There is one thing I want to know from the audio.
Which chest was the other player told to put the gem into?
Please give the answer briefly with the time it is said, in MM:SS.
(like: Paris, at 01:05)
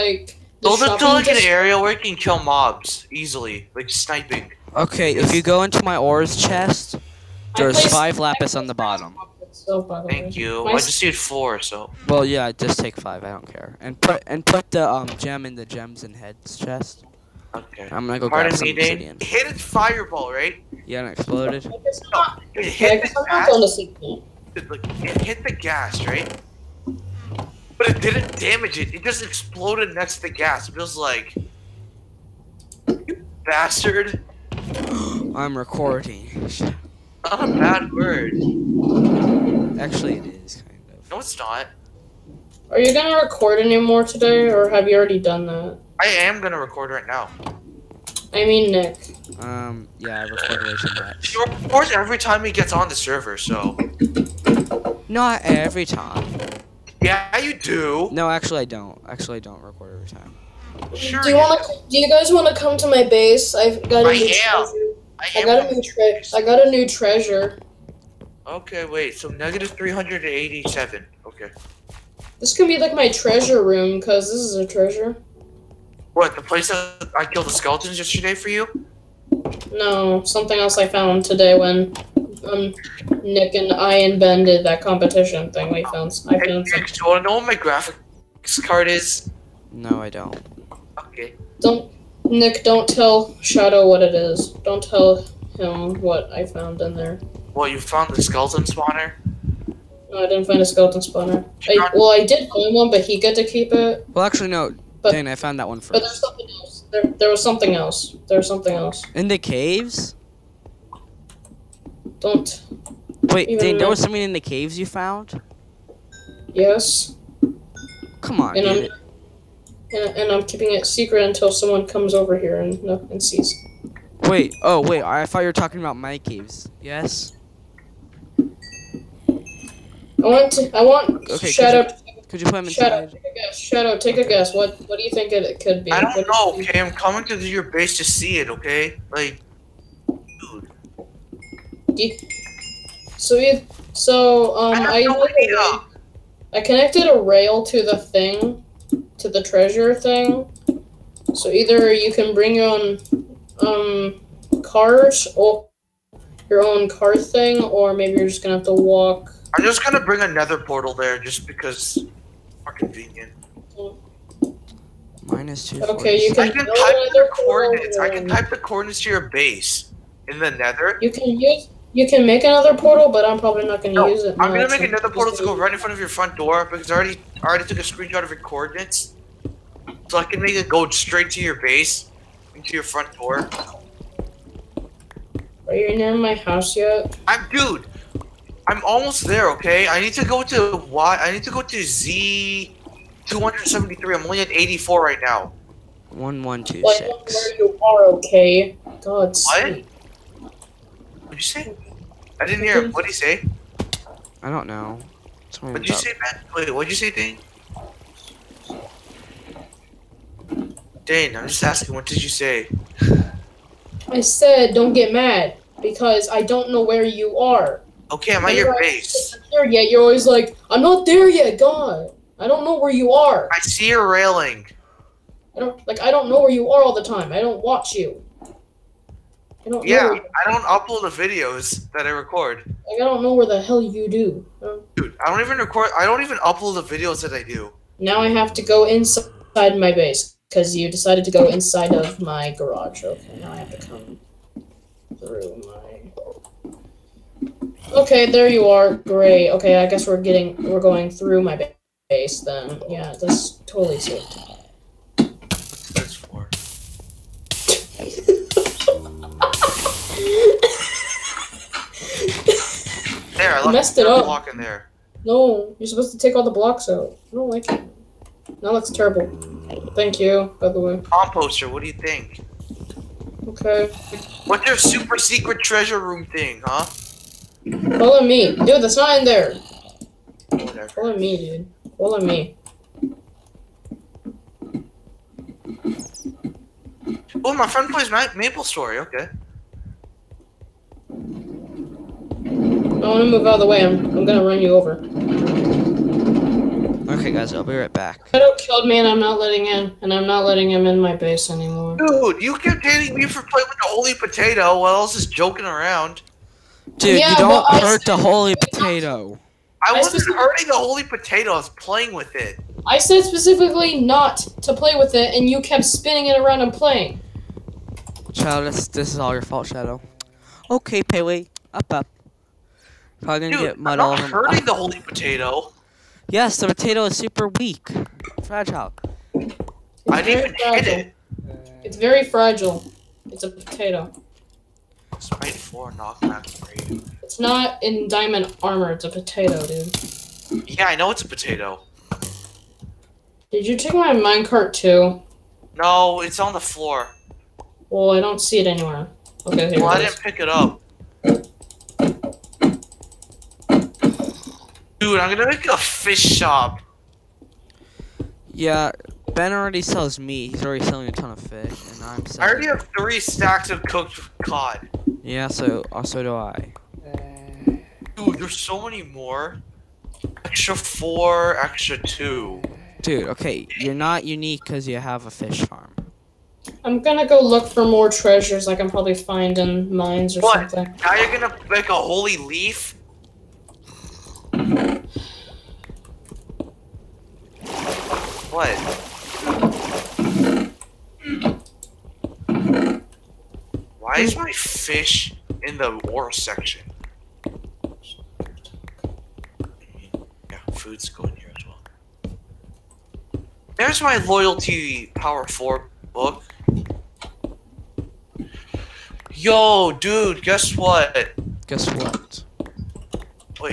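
gems and heads chest, at 00:15.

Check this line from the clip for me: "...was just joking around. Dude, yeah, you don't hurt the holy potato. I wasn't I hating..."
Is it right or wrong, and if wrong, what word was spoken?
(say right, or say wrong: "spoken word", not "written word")
wrong: "hurting", not "hating".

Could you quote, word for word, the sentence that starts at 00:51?
Of records every time he gets on the server, so.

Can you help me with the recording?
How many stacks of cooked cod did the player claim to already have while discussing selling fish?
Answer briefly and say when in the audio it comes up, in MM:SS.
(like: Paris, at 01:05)
3, at 06:02.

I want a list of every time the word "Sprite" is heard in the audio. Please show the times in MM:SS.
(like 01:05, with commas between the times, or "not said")
05:35.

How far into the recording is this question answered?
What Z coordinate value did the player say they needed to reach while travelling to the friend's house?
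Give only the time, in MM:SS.
03:13.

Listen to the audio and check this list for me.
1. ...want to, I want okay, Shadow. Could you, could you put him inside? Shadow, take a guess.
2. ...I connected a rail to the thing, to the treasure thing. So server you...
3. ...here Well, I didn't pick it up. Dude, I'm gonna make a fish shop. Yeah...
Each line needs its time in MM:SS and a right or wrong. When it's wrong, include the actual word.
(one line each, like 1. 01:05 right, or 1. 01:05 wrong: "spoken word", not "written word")
1. 02:10 right
2. 02:26 wrong: "either", not "server"
3. 05:49 right.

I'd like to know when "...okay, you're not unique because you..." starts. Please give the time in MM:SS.
06:13.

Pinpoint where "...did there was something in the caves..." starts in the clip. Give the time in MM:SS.
01:53.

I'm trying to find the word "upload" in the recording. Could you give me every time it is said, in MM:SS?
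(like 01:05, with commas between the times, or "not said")
03:50, 03:56.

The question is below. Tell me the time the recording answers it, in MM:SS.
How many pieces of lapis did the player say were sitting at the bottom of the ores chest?
00:07.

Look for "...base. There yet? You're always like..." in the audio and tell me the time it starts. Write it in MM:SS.
03:38.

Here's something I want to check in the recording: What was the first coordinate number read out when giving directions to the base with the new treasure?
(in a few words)
-387.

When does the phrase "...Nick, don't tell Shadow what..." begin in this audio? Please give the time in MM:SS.
01:32.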